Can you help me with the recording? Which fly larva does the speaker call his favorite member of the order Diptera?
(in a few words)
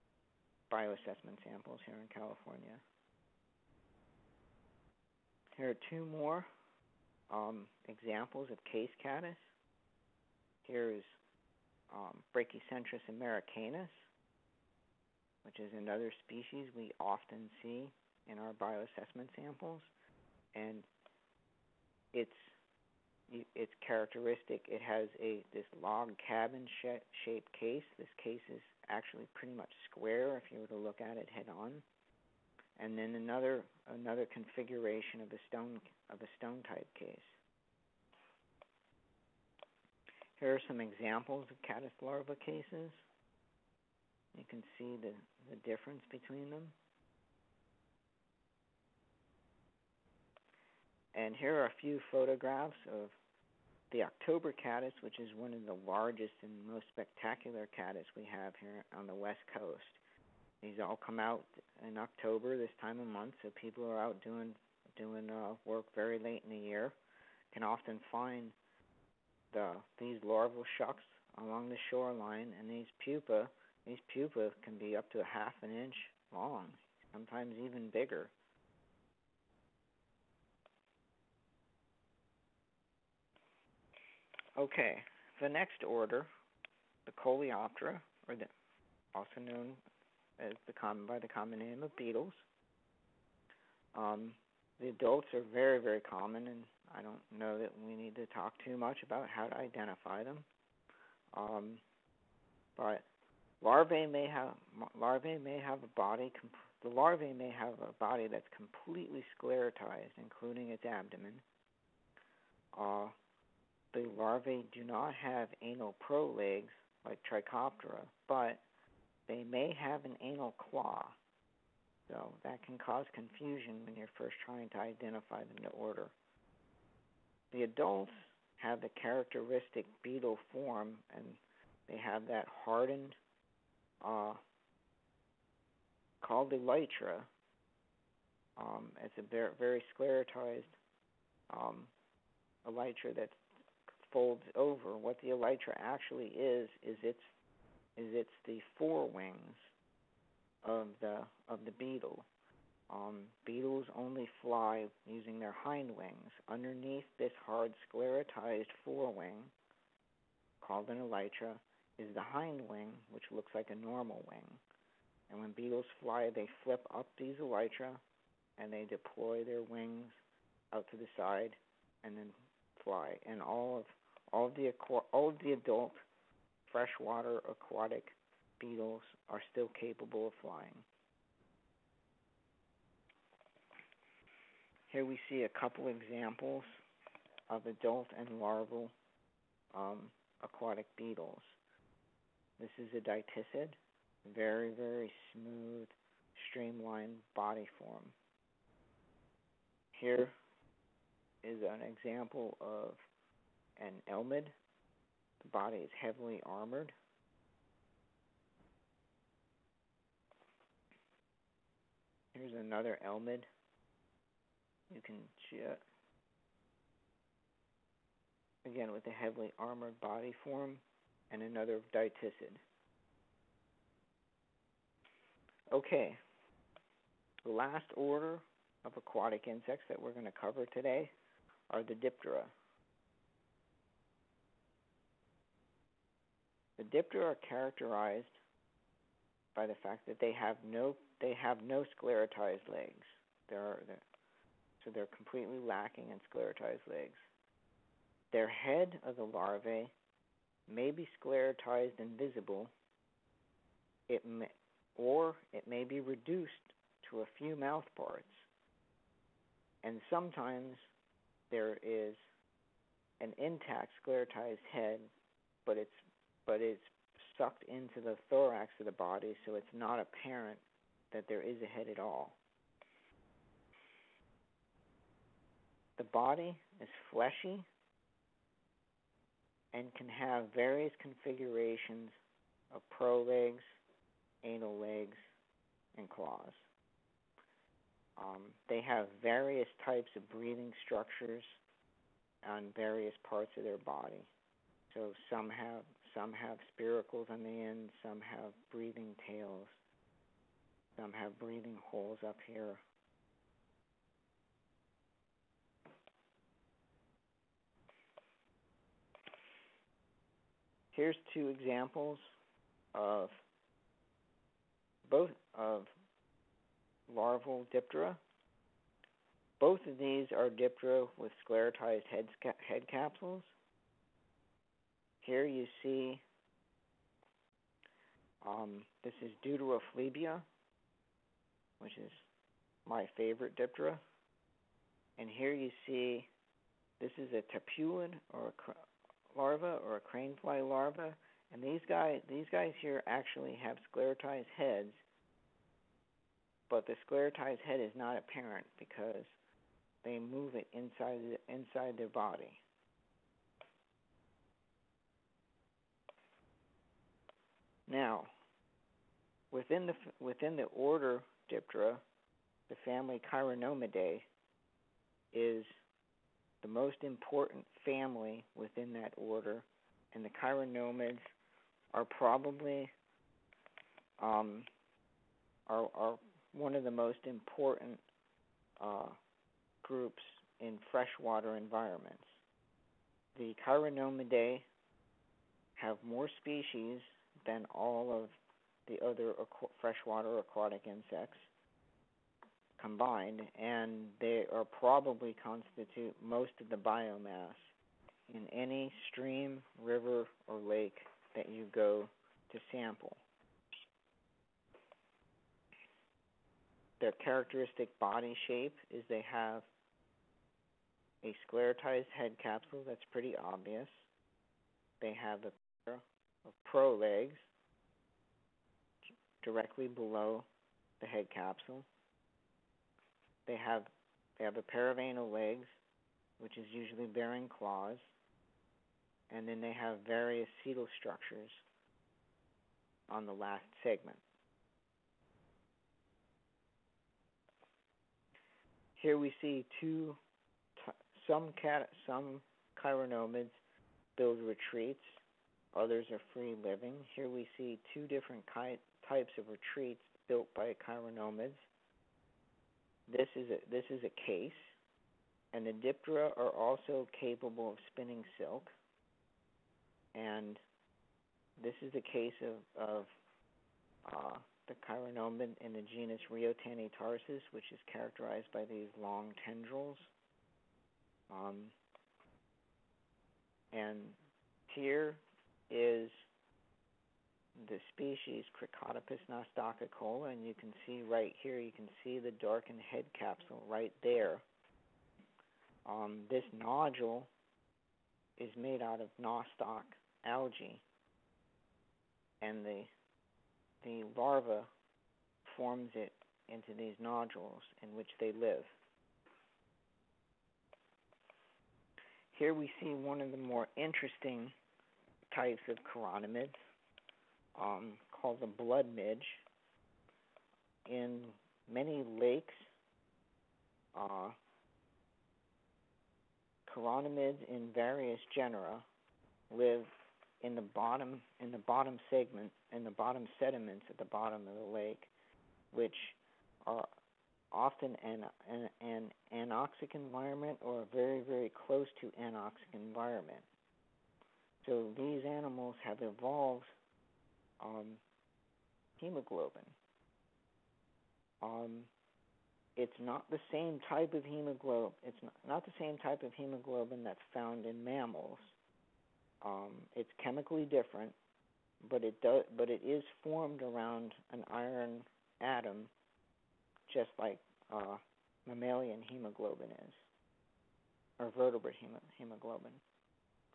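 Deuterophlebia.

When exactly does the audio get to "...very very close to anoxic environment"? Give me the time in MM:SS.
08:50.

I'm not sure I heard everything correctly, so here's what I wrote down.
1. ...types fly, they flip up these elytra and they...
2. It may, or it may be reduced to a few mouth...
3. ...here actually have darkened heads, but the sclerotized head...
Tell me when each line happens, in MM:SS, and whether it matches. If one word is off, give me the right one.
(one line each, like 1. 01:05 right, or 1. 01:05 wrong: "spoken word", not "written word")
1. 02:45 wrong: "beetles", not "types"
2. 04:14 right
3. 05:42 wrong: "sclerotized", not "darkened".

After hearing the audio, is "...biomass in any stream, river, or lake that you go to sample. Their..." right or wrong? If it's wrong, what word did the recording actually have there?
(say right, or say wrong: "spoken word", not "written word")
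right.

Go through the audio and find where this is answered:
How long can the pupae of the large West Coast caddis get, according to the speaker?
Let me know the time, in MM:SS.
01:15.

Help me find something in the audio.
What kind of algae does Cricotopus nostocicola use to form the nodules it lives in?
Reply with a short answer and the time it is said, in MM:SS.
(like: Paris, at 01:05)
nostoc algae, at 08:09.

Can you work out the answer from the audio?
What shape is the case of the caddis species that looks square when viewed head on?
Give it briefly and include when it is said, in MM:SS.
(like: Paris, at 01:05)
log cabin, at 00:25.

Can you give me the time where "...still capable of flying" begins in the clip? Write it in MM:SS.
02:59.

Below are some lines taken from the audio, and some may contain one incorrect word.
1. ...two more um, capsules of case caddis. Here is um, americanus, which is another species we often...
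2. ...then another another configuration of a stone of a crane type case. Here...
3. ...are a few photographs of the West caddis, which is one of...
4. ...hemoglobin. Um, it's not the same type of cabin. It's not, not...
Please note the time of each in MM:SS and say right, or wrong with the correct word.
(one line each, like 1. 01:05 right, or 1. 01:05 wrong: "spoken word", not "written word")
1. 00:05 wrong: "examples", not "capsules"
2. 00:32 wrong: "stone", not "crane"
3. 00:51 wrong: "October", not "West"
4. 08:58 wrong: "hemoglobin", not "cabin".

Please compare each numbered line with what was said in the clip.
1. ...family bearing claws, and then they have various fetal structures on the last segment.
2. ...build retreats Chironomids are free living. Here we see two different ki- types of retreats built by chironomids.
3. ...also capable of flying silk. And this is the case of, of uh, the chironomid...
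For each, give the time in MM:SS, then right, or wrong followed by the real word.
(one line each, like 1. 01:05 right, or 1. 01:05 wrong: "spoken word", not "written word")
1. 07:06 wrong: "usually", not "family"
2. 07:24 wrong: "Others", not "Chironomids"
3. 07:36 wrong: "spinning", not "flying".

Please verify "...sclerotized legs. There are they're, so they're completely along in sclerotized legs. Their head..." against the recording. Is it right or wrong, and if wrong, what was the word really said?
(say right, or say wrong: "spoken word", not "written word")
wrong: "lacking", not "along".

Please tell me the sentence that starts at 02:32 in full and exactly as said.
Um, beetles only fly using their hind wings.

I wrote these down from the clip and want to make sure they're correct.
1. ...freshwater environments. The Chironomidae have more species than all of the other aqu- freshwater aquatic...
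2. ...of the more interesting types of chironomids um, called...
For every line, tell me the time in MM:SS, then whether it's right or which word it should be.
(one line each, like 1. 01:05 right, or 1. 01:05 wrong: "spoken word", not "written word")
1. 06:20 right
2. 08:23 right.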